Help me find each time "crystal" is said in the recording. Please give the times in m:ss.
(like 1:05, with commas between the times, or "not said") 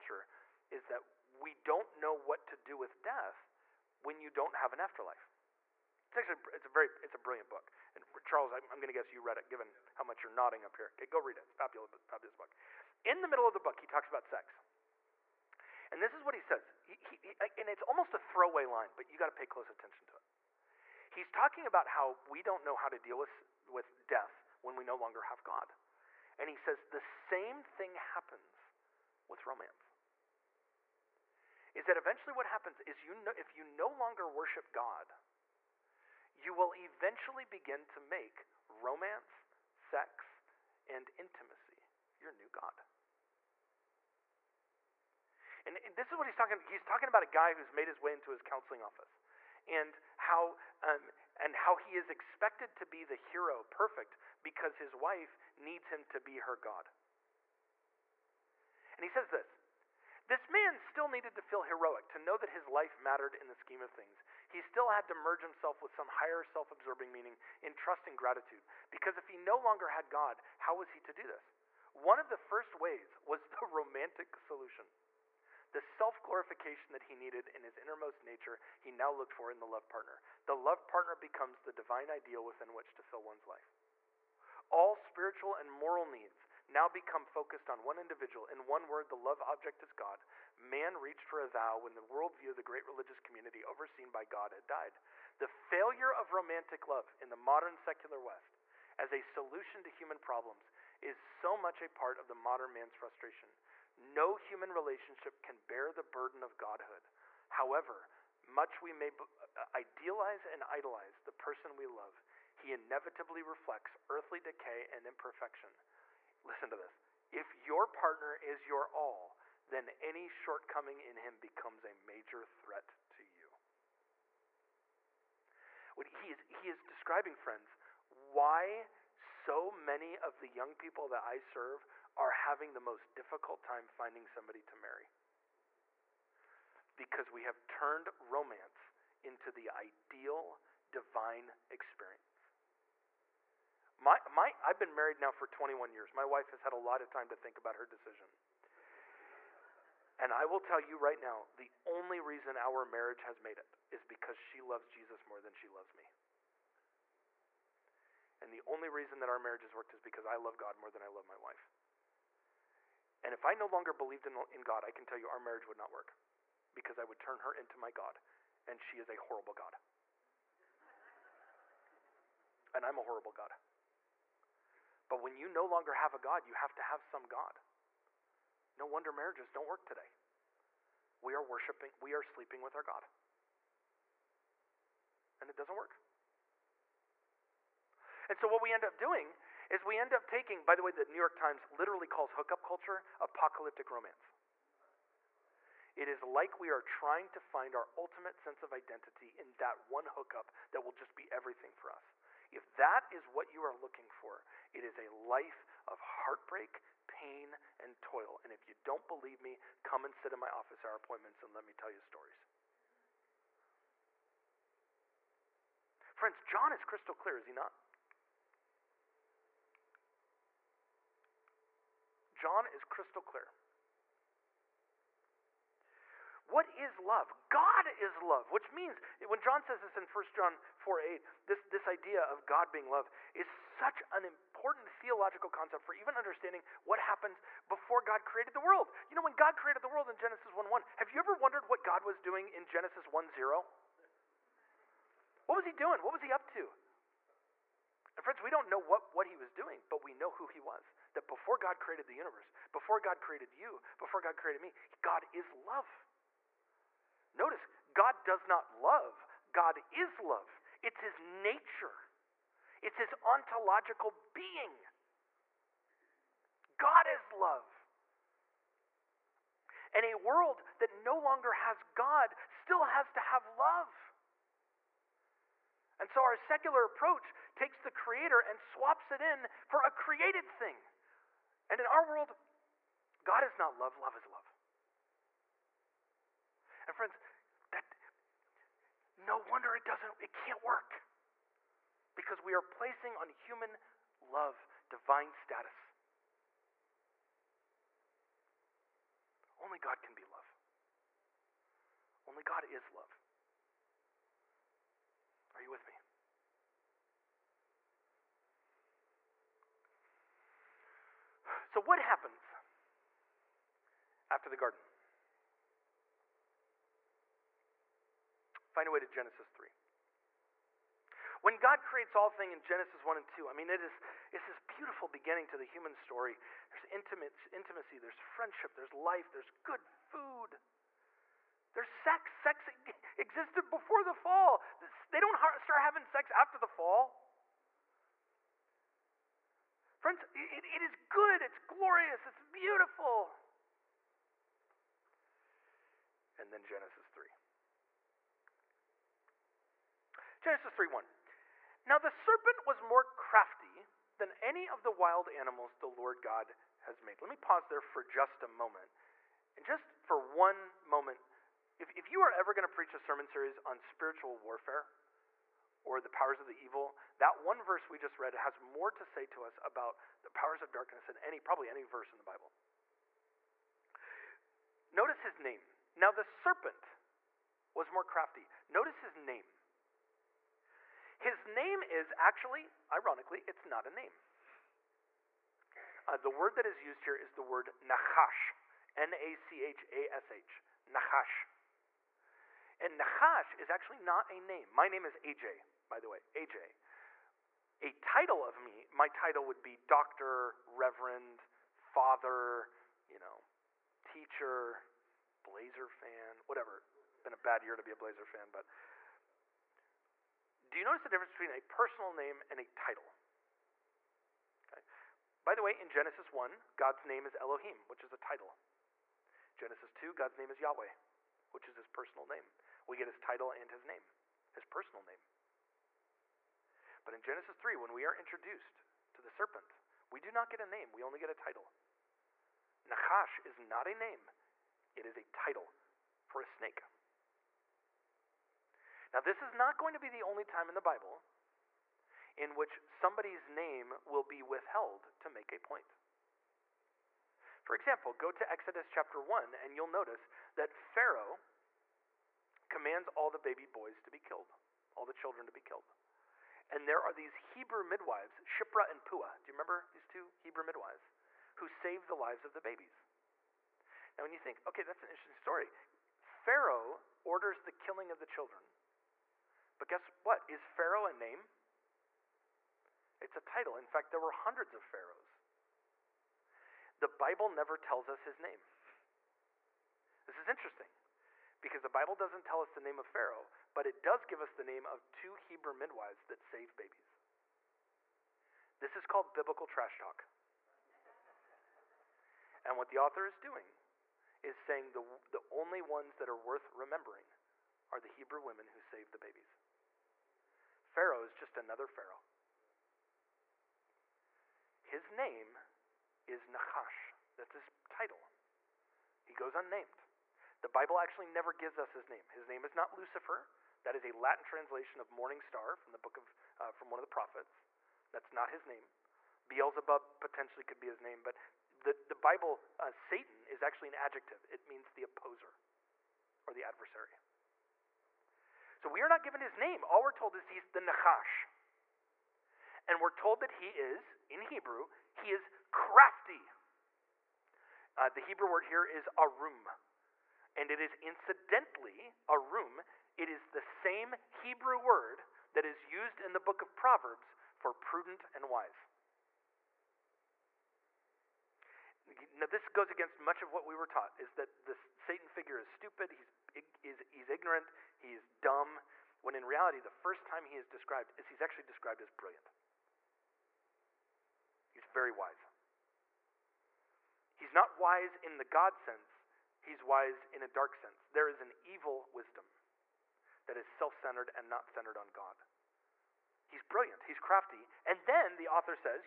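3:36, 3:42.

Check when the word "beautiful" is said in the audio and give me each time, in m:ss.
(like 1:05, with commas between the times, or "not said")
5:24, 5:42.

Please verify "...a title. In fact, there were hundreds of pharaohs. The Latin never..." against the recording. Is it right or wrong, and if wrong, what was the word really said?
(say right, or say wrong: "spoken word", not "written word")
wrong: "Bible", not "Latin".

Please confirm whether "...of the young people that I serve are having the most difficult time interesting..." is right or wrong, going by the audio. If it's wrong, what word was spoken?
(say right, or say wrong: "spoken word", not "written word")
wrong: "finding", not "interesting".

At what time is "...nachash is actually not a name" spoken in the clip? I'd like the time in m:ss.
6:32.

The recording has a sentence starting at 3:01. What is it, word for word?
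We are worshiping, we are sleeping with our God.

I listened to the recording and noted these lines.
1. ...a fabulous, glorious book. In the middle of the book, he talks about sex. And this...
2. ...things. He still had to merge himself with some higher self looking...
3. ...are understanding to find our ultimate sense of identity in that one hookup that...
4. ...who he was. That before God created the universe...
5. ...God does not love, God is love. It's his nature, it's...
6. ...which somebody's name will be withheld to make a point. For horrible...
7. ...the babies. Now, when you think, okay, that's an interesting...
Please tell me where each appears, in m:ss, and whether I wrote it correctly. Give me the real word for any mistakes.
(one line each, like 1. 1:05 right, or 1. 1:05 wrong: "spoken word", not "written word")
1. 0:11 wrong: "fabulous", not "glorious"
2. 1:03 wrong: "absorbing", not "looking"
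3. 3:16 wrong: "trying", not "understanding"
4. 4:10 right
5. 4:17 right
6. 7:22 wrong: "example", not "horrible"
7. 7:42 right.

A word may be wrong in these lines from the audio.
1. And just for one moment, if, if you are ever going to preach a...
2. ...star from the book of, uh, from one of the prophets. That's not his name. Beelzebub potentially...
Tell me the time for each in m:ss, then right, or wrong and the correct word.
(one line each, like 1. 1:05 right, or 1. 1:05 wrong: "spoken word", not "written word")
1. 5:59 right
2. 8:35 right.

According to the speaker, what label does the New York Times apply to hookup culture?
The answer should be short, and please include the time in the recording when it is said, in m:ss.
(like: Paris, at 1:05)
apocalyptic romance, at 3:13.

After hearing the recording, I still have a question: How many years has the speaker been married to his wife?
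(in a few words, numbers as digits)
21.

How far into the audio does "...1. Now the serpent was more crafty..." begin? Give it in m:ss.
5:50.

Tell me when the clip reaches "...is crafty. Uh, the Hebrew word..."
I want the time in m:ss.
8:55.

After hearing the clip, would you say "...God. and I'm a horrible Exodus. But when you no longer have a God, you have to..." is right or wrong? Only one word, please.
wrong.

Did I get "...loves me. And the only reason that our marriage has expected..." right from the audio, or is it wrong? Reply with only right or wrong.
wrong.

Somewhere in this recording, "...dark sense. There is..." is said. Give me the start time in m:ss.
9:30.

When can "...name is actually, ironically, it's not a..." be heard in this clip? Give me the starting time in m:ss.
6:21.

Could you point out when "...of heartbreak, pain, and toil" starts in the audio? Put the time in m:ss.
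3:25.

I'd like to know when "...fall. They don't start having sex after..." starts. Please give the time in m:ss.
5:34.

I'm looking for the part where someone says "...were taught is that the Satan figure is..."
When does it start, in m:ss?
9:13.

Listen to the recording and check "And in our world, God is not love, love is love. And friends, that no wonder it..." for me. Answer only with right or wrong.
right.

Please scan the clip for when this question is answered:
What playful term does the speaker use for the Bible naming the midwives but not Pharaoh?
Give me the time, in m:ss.
8:09.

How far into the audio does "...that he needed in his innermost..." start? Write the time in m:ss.
1:16.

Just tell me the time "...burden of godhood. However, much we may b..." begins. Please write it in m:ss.
1:46.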